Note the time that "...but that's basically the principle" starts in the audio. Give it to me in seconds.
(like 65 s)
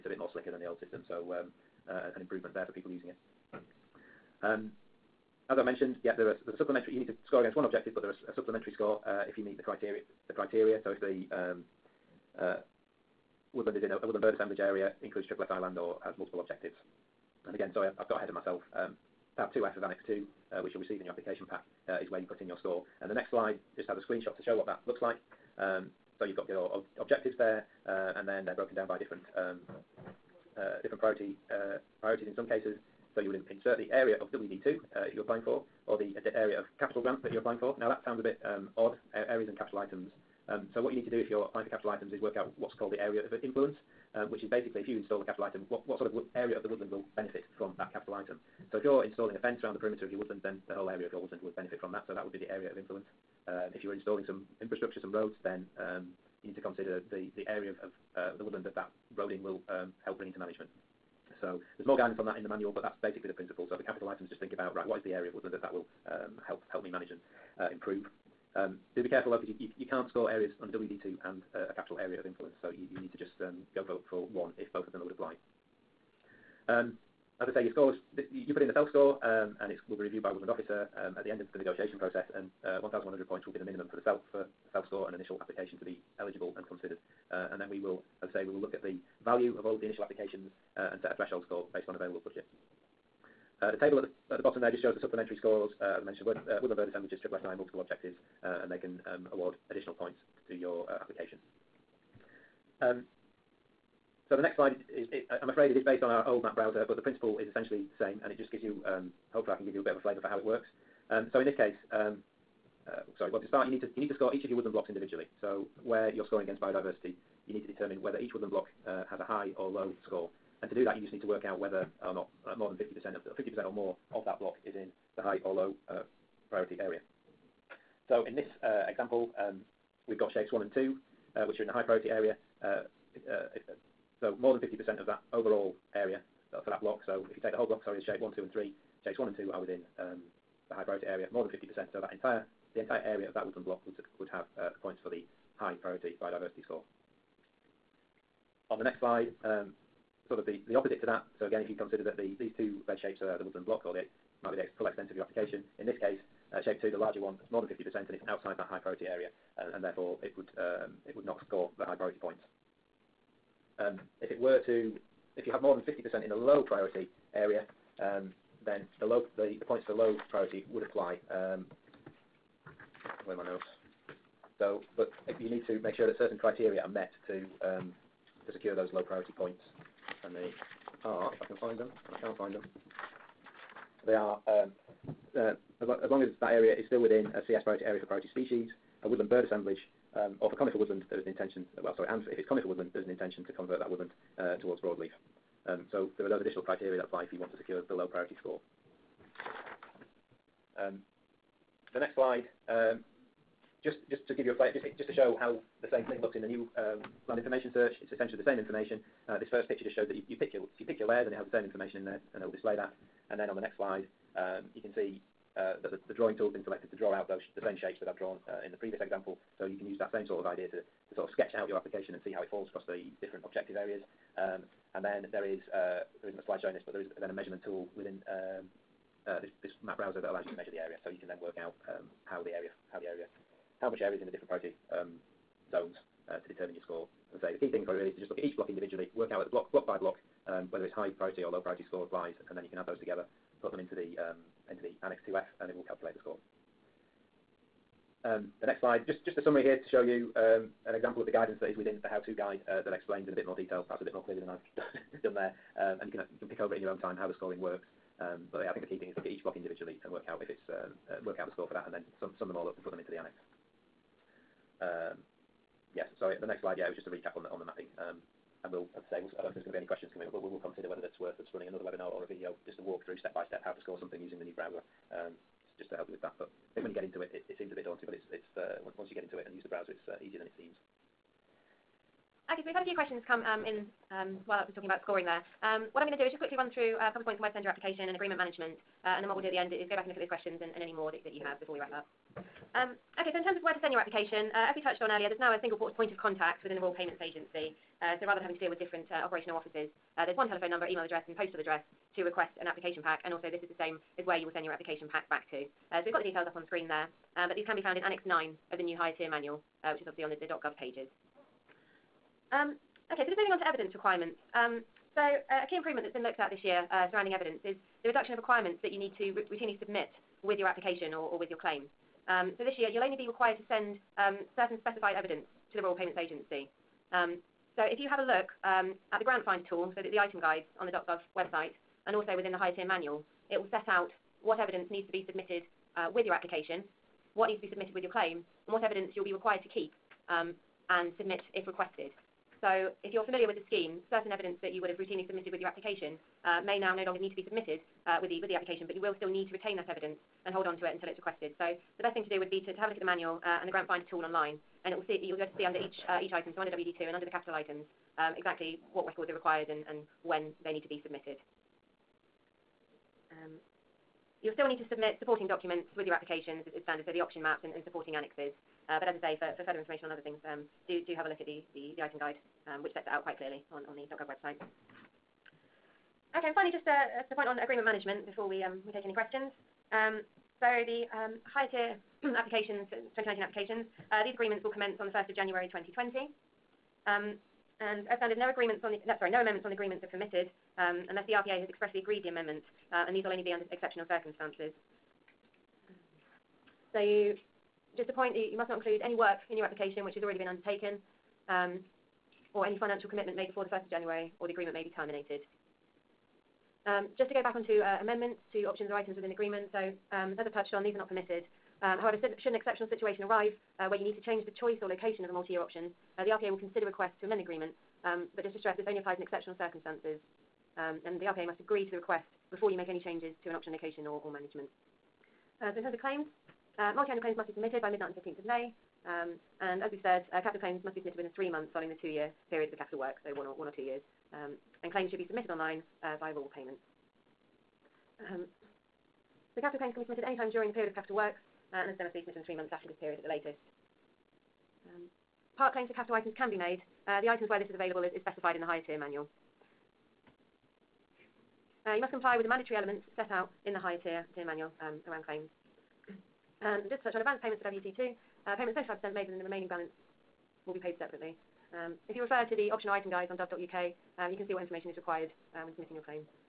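62 s.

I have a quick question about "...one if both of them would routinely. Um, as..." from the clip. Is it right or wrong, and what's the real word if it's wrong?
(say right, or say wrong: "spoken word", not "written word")
wrong: "apply", not "routinely".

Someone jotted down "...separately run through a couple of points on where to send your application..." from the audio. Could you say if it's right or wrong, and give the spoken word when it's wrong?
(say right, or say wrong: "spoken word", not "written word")
wrong: "quickly", not "separately".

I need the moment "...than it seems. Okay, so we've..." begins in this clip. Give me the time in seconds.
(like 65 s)
280 s.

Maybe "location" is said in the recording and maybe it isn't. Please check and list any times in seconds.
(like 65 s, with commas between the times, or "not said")
414 s, 423 s.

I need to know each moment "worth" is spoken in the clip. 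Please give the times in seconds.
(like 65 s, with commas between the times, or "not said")
271 s.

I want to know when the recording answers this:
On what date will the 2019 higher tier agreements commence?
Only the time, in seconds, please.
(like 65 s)
385 s.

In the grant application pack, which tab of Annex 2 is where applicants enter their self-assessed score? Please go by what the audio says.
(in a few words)
Tab 2F.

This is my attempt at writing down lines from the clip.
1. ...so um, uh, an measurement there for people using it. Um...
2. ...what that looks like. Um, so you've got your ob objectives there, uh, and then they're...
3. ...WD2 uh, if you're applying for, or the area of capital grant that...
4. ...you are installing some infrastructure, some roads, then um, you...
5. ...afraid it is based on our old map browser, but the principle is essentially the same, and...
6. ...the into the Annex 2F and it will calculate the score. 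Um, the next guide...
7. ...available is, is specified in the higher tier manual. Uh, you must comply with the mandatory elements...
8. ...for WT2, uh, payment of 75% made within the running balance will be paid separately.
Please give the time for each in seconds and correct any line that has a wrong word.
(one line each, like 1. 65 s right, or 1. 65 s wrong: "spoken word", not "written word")
1. 1 s wrong: "improvement", not "measurement"
2. 24 s right
3. 34 s right
4. 53 s right
5. 105 s right
6. 243 s wrong: "slide", not "guide"
7. 447 s right
8. 457 s wrong: "remaining", not "running".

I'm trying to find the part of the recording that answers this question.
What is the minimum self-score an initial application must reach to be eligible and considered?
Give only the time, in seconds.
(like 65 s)
82 s.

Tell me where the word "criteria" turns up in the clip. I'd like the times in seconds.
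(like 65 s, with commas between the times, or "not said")
9 s, 176 s, 196 s.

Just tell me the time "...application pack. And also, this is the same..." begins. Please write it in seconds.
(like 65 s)
302 s.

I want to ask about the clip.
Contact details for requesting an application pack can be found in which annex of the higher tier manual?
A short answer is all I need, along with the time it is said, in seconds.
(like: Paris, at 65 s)
Annex 9, at 308 s.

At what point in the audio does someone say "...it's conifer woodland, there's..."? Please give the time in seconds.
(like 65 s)
192 s.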